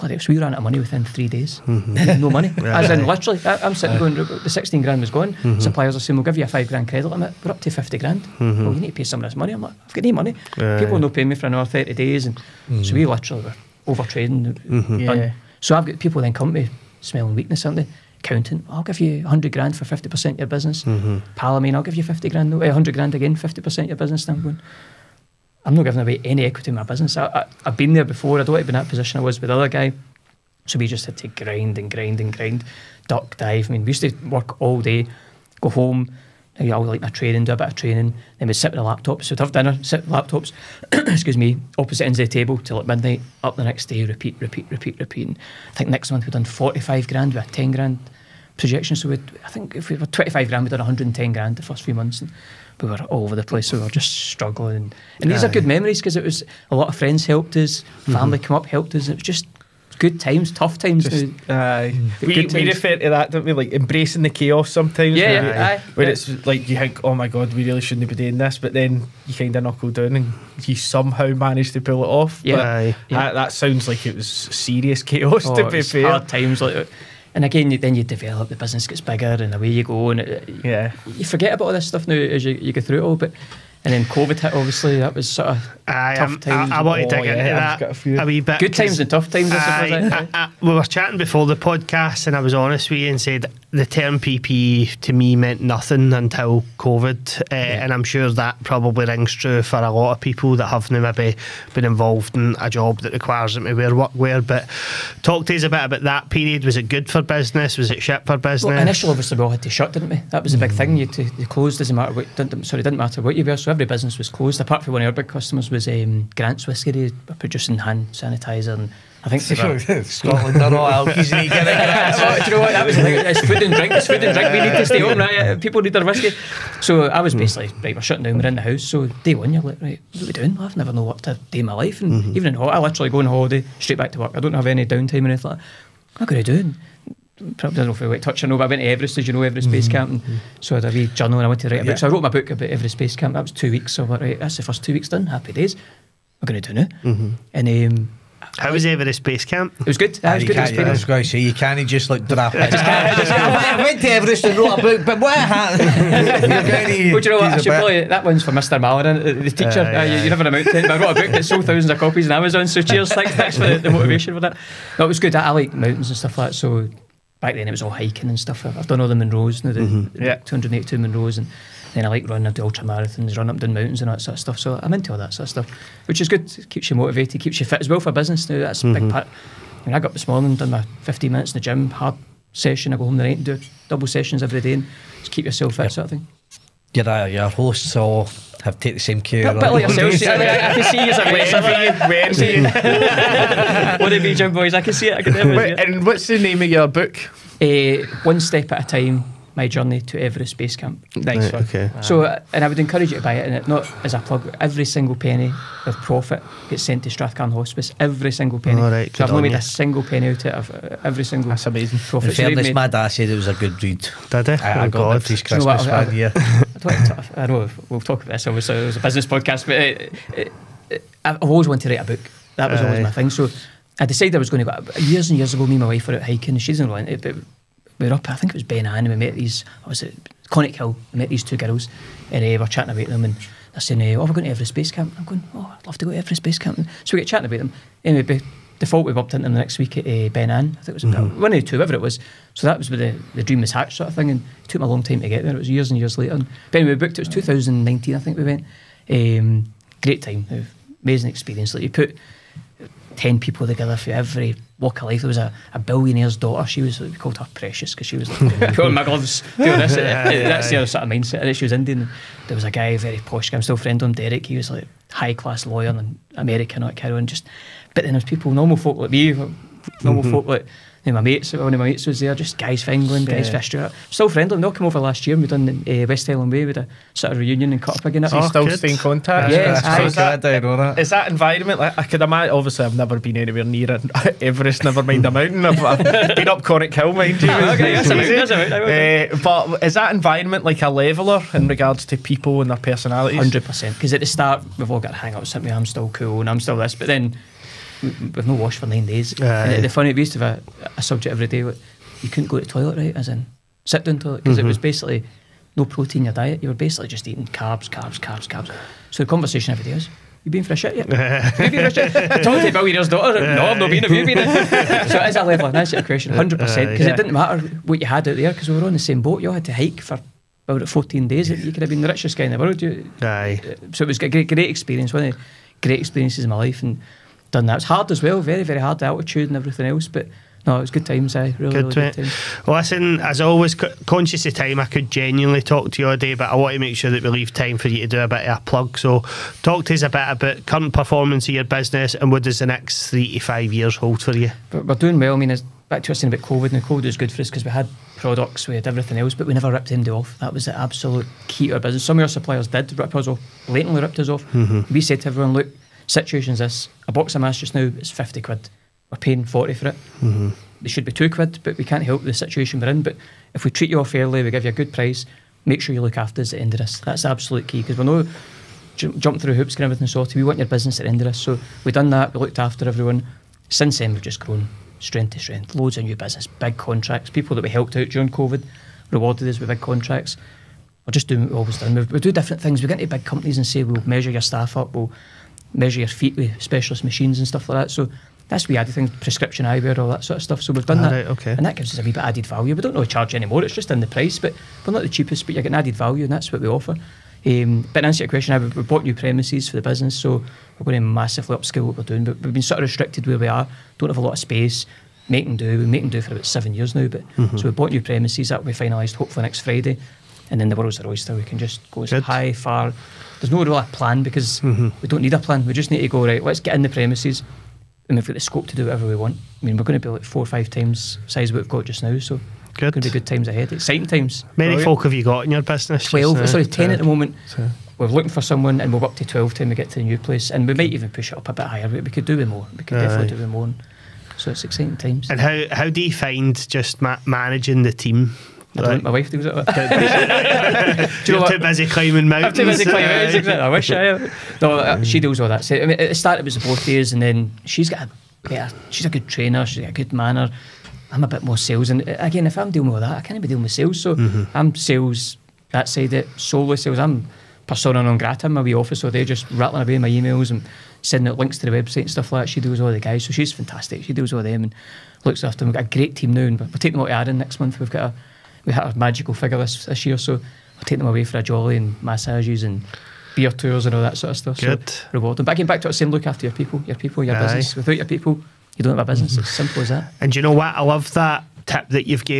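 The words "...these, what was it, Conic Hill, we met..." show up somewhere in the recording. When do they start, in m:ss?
3:49.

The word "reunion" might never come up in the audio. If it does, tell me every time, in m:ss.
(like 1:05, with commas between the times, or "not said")
4:37.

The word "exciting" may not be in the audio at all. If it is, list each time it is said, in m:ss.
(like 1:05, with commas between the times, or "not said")
7:03, 7:14.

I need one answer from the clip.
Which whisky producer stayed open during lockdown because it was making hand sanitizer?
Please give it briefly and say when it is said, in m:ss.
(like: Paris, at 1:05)
Grant's Whisky, at 1:56.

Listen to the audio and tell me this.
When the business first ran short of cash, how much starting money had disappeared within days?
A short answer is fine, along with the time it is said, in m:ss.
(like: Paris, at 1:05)
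16 grand, at 0:04.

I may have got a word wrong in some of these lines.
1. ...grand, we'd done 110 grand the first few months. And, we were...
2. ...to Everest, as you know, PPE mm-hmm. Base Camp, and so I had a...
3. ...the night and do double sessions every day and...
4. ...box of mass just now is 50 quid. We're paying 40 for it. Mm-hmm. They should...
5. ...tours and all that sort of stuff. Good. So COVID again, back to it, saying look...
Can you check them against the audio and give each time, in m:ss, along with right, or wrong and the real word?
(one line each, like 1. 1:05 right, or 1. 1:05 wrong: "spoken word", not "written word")
1. 0:50 right
2. 2:18 wrong: "Everest", not "PPE"
3. 3:03 right
4. 5:57 right
5. 7:53 wrong: "But", not "COVID".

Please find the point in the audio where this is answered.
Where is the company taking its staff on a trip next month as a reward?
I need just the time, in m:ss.
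7:47.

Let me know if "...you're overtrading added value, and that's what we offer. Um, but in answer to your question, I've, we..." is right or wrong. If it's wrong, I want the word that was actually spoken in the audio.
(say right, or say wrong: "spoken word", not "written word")
wrong: "getting", not "overtrading".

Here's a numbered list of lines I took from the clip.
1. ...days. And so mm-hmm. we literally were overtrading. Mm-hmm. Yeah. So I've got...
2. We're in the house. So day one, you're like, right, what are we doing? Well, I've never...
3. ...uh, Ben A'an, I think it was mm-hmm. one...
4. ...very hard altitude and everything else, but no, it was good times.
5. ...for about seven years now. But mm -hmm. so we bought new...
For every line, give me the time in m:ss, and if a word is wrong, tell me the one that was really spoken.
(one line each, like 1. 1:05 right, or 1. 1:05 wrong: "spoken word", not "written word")
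1. 0:11 right
2. 2:08 right
3. 4:00 right
4. 5:28 right
5. 6:46 right.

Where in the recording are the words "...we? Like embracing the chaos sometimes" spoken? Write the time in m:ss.
1:03.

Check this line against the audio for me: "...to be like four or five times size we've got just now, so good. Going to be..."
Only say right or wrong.
right.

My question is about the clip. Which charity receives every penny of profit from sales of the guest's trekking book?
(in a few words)
Strathcarron Hospice.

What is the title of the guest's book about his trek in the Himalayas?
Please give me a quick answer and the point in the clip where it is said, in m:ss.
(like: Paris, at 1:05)
One Step at a Time, at 3:18.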